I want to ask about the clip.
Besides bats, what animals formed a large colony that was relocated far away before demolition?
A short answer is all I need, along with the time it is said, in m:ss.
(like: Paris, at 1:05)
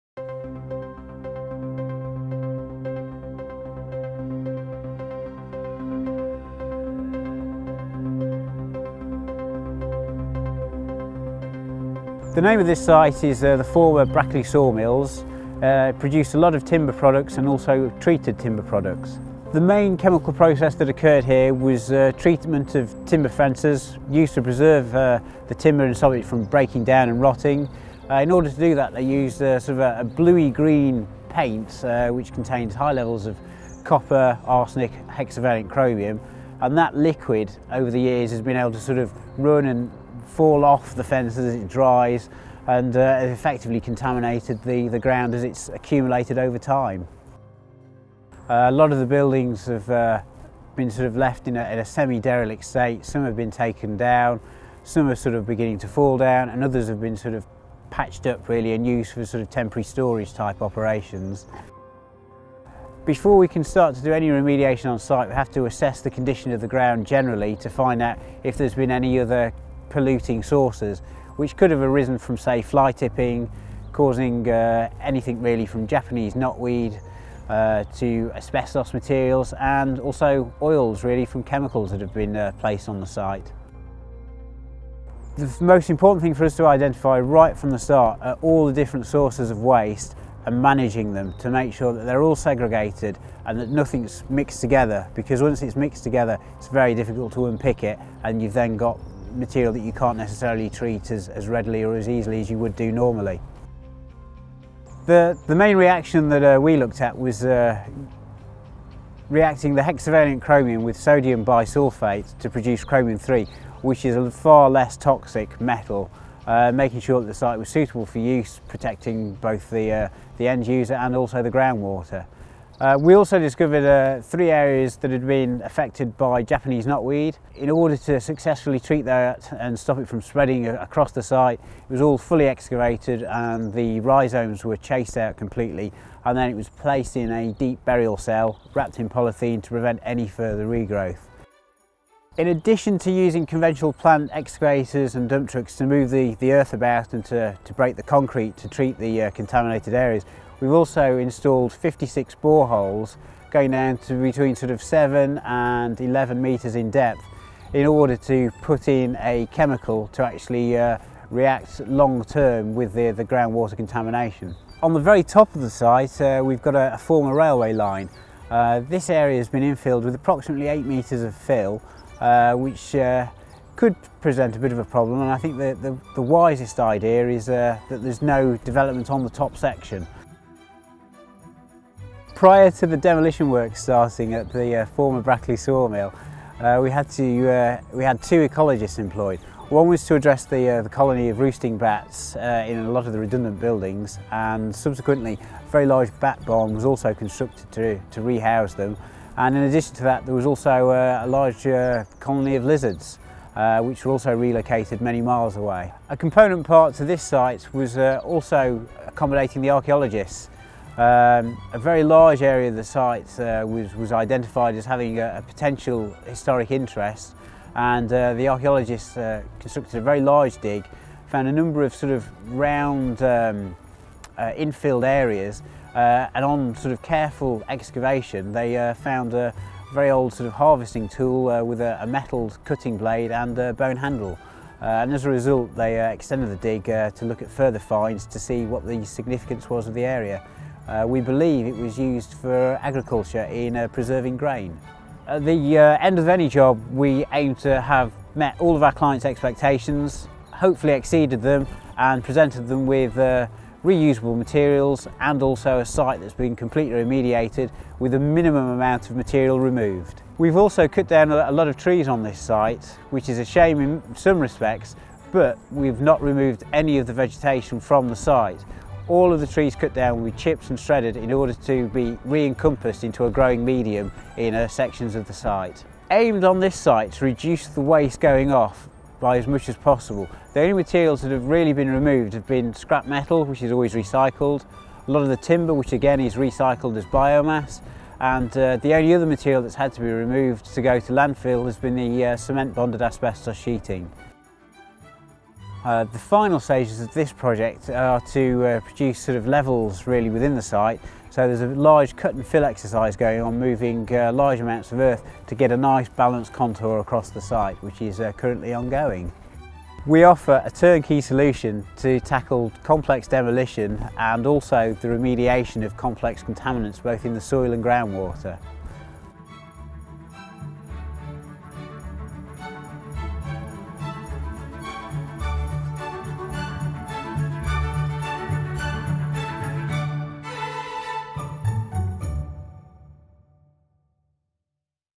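lizards, at 3:22.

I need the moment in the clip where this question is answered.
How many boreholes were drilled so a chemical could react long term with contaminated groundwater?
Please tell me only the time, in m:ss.
2:31.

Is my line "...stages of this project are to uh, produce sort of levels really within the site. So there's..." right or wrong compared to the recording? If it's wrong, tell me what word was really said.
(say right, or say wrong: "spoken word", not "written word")
right.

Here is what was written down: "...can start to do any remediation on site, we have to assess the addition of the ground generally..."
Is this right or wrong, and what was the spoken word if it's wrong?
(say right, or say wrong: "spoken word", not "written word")
wrong: "condition", not "addition".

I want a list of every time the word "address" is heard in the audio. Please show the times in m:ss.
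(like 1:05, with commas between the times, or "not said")
3:10.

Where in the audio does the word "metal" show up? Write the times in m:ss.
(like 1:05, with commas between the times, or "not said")
1:55, 3:52, 4:43.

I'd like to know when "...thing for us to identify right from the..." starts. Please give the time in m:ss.
1:26.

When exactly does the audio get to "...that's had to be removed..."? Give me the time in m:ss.
4:49.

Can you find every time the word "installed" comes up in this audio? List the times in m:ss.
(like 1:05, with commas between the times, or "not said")
2:31.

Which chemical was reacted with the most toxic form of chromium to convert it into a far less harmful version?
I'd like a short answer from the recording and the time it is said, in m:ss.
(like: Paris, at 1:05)
sodium bisulfate, at 1:50.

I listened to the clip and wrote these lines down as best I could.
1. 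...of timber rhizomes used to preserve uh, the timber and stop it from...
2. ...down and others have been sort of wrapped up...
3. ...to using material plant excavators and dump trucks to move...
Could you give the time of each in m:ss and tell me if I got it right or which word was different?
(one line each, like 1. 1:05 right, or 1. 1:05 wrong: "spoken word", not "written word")
1. 0:22 wrong: "fences", not "rhizomes"
2. 0:56 wrong: "patched", not "wrapped"
3. 2:22 wrong: "conventional", not "material".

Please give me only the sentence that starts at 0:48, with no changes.
Uh, a lot of the buildings have uh, been sort of left in a, a semi-derelict state.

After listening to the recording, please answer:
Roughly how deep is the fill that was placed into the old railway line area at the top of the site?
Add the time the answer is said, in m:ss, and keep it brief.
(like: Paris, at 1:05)
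8 metres, at 2:50.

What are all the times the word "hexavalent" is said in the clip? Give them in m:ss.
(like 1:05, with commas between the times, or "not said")
0:35, 1:49.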